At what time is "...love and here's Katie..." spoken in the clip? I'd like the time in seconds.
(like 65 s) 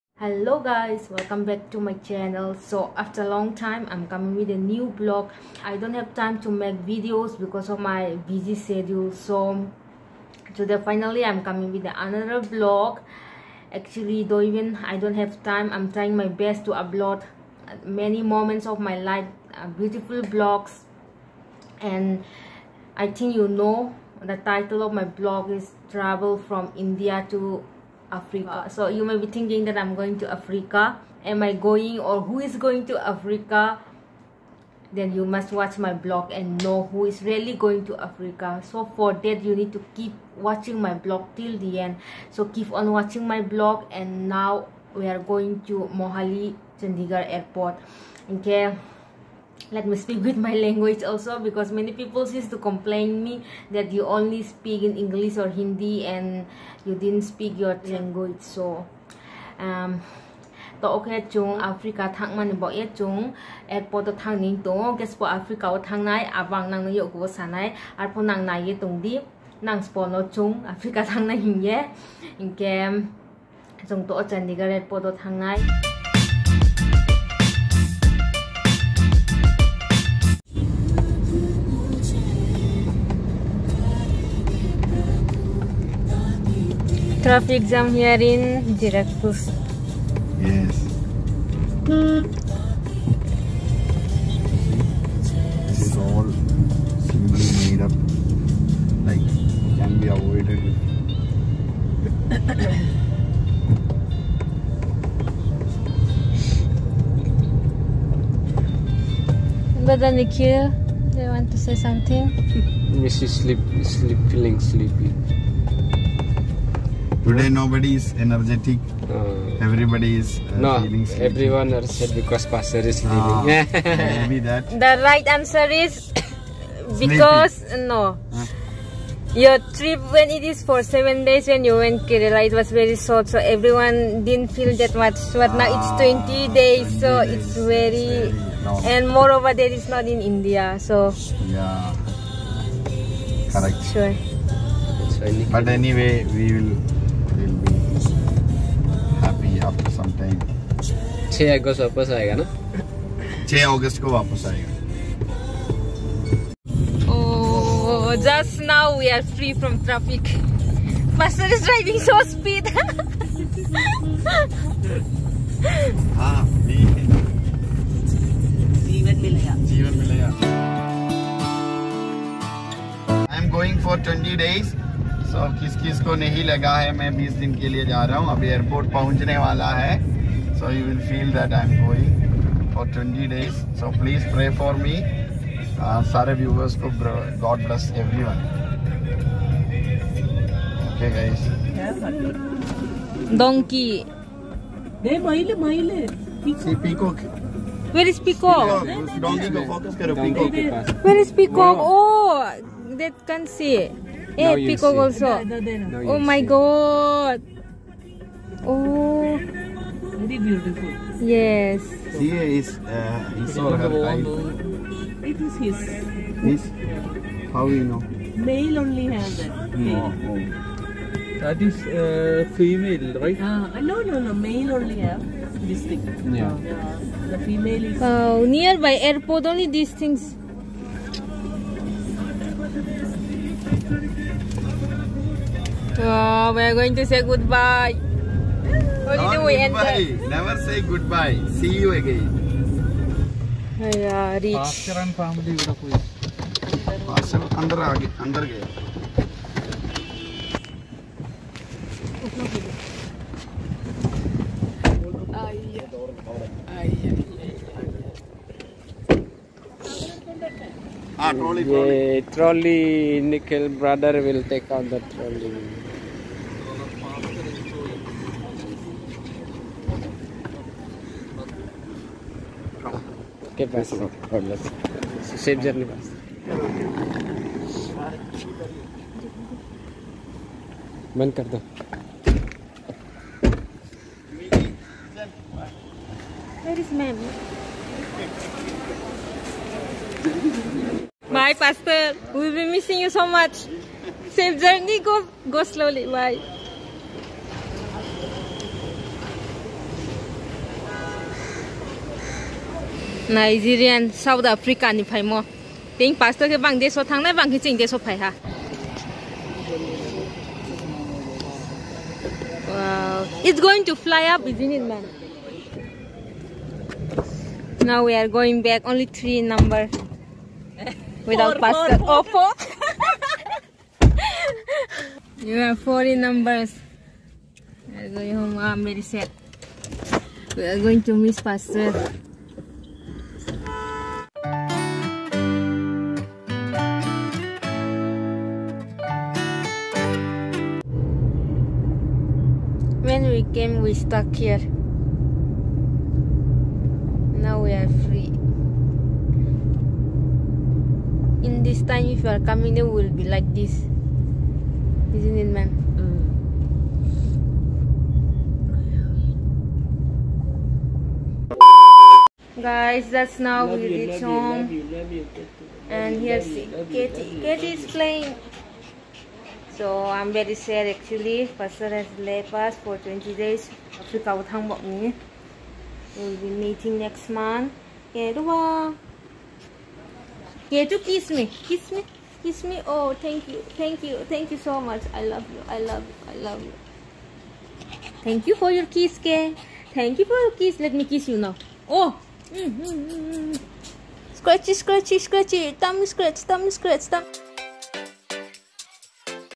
365 s.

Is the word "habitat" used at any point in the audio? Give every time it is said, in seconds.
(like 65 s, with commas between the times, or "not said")
not said.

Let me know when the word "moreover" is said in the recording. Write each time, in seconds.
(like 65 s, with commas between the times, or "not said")
139 s.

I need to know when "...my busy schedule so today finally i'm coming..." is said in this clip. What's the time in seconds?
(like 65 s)
7 s.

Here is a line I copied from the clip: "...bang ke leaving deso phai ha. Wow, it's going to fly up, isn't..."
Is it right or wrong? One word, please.
wrong.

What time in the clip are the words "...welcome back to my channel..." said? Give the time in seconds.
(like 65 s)
1 s.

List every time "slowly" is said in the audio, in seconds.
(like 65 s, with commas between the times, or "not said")
295 s.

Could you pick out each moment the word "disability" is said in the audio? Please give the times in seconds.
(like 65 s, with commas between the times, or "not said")
not said.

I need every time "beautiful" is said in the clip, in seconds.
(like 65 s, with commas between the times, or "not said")
19 s, 210 s.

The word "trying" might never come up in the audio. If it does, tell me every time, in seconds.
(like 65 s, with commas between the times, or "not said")
15 s.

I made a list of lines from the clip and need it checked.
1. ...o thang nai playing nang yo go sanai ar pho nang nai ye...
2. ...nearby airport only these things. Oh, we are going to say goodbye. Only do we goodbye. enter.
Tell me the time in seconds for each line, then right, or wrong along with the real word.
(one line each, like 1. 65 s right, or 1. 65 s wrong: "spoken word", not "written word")
1. 65 s wrong: "awang", not "playing"
2. 228 s right.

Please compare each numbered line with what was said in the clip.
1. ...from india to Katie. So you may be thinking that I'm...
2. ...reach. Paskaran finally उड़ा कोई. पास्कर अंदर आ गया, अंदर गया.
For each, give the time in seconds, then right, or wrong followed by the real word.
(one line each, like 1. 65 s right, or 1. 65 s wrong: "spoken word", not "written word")
1. 26 s wrong: "Africa", not "Katie"
2. 244 s wrong: "family", not "finally".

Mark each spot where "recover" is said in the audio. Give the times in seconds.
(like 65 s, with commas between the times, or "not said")
not said.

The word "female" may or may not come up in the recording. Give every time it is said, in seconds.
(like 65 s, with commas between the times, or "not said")
222 s, 227 s.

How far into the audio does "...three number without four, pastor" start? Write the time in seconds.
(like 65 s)
319 s.